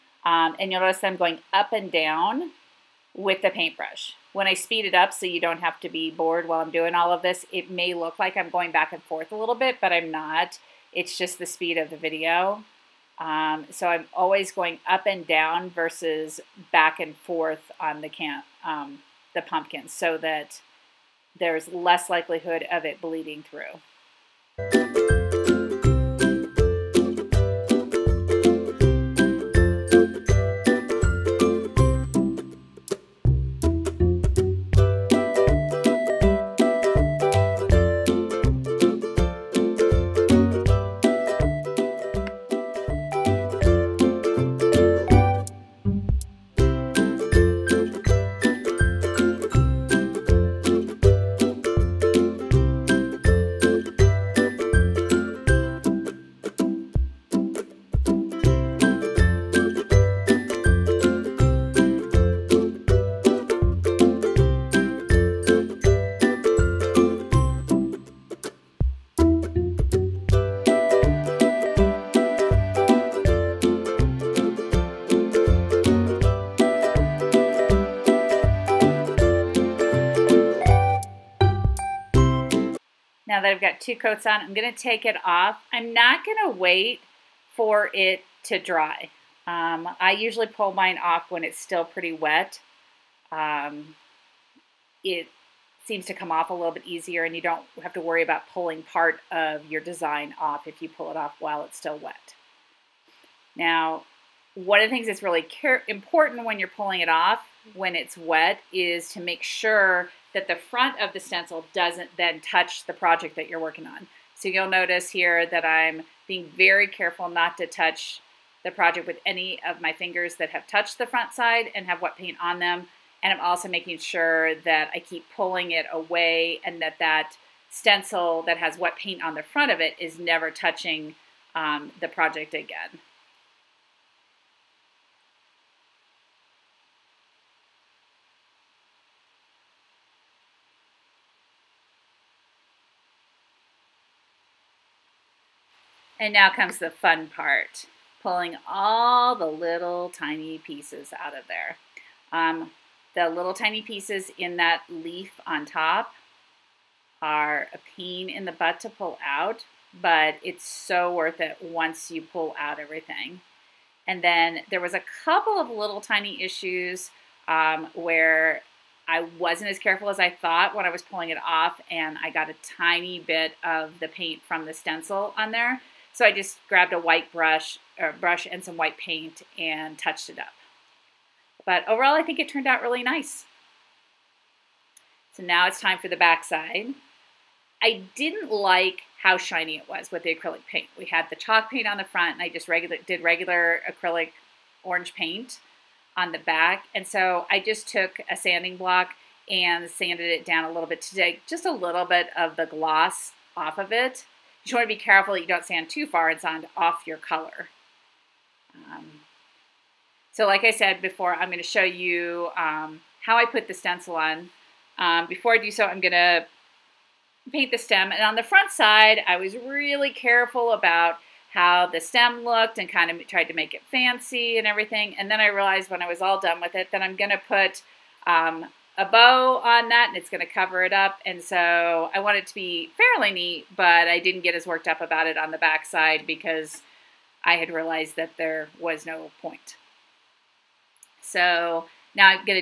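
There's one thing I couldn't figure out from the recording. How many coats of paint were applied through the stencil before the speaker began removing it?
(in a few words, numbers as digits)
2.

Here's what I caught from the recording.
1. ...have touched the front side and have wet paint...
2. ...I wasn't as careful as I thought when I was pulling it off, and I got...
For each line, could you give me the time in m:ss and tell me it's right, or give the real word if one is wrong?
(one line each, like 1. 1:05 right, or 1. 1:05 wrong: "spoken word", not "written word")
1. 2:00 right
2. 2:49 right.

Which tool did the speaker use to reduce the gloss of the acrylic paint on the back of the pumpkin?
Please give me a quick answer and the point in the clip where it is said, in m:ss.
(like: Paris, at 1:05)
Sanding block, at 3:18.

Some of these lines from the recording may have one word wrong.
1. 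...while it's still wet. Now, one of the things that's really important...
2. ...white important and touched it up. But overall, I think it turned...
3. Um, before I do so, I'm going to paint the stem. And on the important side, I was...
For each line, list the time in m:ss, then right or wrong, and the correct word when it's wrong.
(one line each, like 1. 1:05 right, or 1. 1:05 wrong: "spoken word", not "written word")
1. 1:41 right
2. 2:58 wrong: "paint", not "important"
3. 3:34 wrong: "front", not "important".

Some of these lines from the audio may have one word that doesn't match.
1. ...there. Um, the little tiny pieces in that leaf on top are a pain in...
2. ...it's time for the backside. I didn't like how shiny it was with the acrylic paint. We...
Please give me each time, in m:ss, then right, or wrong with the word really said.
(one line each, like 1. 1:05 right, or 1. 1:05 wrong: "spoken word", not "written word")
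1. 2:31 right
2. 3:05 right.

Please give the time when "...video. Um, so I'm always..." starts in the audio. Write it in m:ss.
0:11.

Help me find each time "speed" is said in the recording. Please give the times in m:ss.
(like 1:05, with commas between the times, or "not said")
0:04, 0:11.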